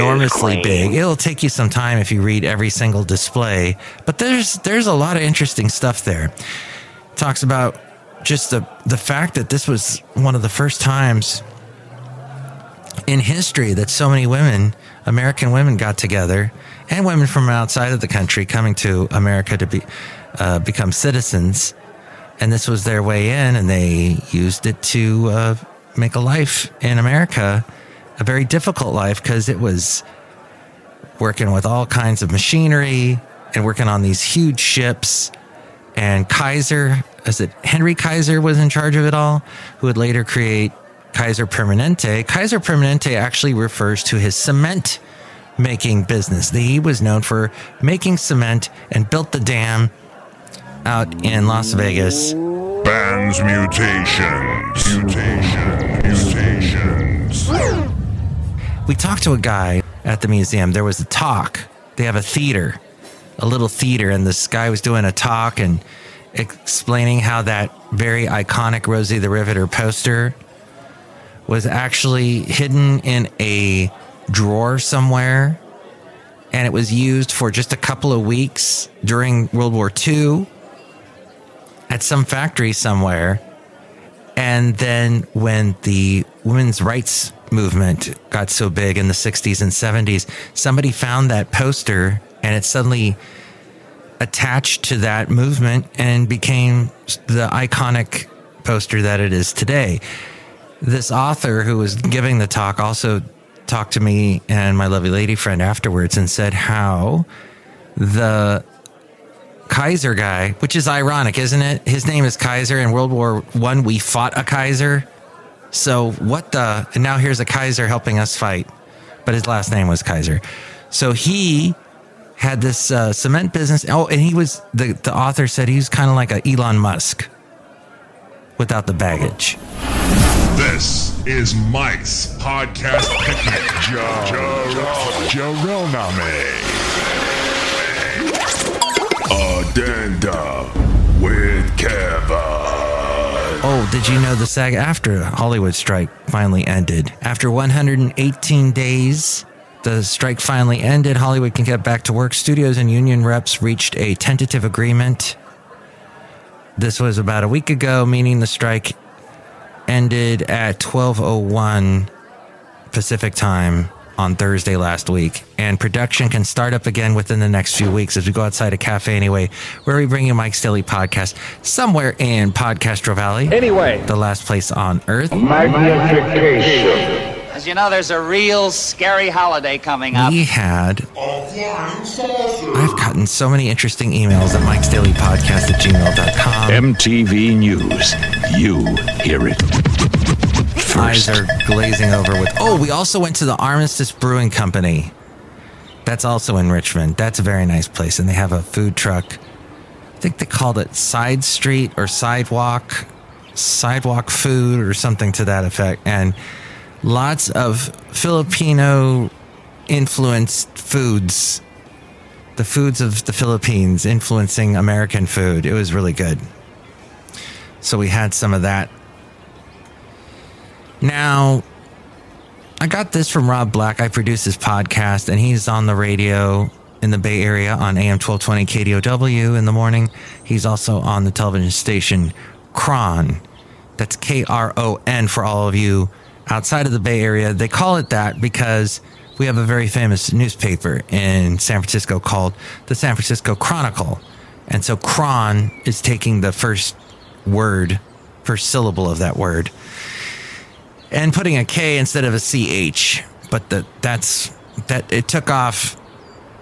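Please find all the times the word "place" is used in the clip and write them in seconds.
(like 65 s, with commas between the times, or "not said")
174 s, 197 s.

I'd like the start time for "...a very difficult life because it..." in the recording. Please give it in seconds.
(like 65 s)
28 s.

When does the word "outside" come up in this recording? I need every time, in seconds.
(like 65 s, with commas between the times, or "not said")
17 s, 168 s, 236 s.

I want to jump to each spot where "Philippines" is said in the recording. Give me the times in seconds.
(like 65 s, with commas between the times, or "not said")
213 s.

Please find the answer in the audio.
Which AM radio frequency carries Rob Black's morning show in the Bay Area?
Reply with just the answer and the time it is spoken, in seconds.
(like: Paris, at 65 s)
AM 1220, at 227 s.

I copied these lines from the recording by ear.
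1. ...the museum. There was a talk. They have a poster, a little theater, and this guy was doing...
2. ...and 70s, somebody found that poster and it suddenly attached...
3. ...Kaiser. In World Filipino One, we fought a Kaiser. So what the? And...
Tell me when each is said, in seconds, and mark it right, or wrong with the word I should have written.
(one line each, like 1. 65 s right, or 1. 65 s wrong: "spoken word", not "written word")
1. 60 s wrong: "theater", not "poster"
2. 89 s right
3. 112 s wrong: "War", not "Filipino".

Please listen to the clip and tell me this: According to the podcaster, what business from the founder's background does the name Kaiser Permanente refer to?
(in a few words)
Cement making business.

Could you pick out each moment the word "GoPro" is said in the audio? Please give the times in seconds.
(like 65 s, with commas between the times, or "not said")
not said.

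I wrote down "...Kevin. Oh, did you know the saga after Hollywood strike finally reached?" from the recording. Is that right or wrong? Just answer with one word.
wrong.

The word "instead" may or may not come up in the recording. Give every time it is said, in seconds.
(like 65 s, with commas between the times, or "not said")
251 s.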